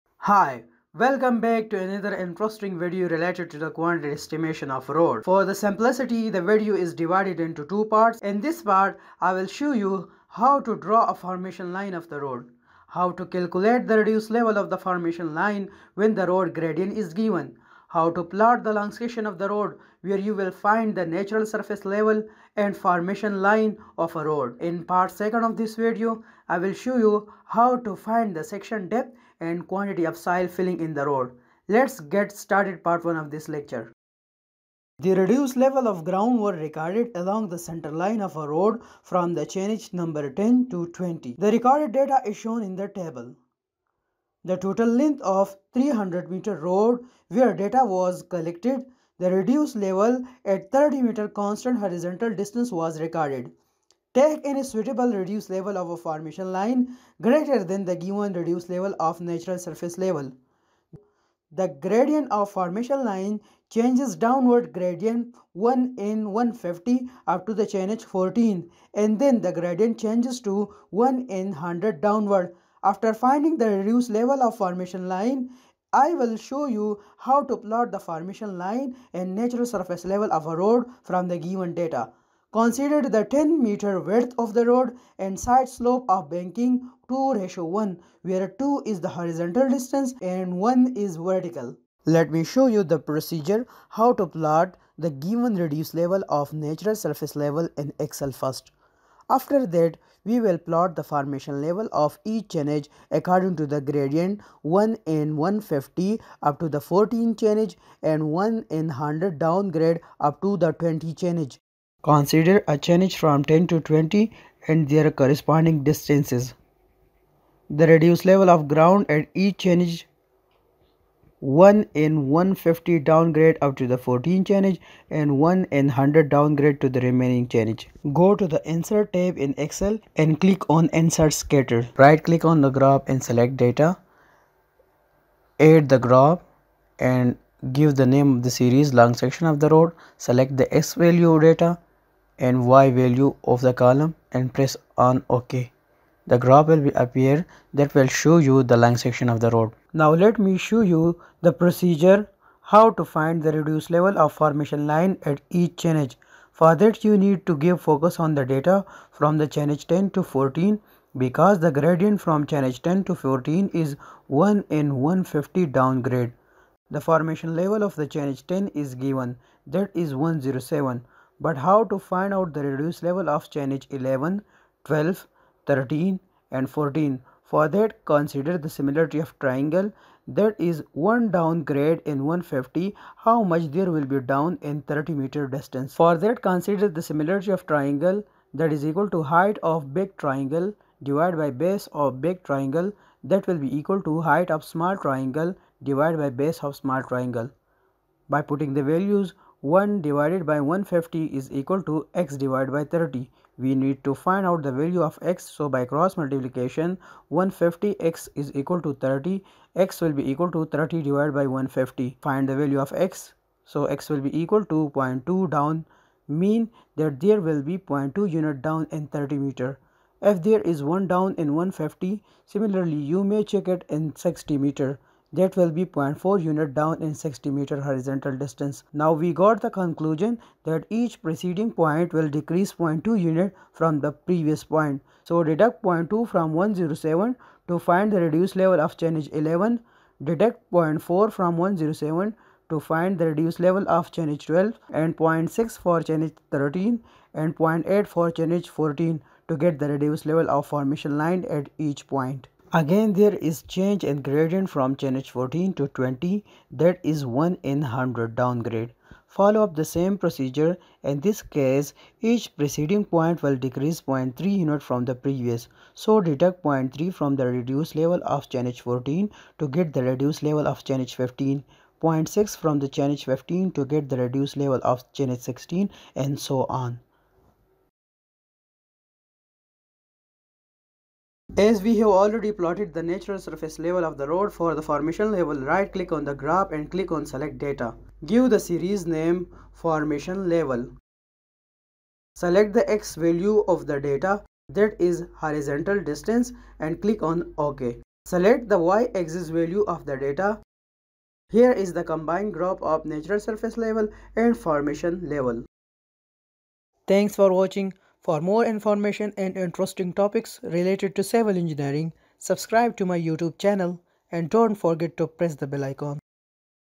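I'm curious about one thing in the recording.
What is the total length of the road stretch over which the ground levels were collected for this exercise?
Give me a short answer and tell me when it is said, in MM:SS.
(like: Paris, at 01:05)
300 meter, at 00:45.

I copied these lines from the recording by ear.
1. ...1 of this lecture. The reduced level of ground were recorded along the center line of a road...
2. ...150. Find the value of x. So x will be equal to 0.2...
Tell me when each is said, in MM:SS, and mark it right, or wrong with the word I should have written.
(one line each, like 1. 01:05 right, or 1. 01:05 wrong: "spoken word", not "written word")
1. 00:33 right
2. 03:31 right.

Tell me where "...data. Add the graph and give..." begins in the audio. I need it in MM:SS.
02:13.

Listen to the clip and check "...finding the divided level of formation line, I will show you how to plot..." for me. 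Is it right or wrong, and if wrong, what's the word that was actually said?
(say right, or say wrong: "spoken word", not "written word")
wrong: "reduced", not "divided".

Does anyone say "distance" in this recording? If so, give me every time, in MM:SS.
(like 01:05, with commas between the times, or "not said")
00:52, 01:29, 01:55, 03:05, 03:48, 04:56.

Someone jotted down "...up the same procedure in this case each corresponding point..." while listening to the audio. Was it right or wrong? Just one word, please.
wrong.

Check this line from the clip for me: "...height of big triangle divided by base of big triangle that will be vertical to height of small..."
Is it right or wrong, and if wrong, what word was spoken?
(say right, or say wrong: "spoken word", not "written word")
wrong: "equal", not "vertical".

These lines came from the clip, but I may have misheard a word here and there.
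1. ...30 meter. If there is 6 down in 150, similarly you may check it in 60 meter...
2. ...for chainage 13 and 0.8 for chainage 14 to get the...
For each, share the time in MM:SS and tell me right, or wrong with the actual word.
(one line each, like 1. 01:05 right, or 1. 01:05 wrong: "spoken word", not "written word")
1. 03:39 wrong: "1", not "6"
2. 04:05 right.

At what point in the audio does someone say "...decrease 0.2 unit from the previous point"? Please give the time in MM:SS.
03:52.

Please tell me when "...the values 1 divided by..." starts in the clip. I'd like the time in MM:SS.
03:18.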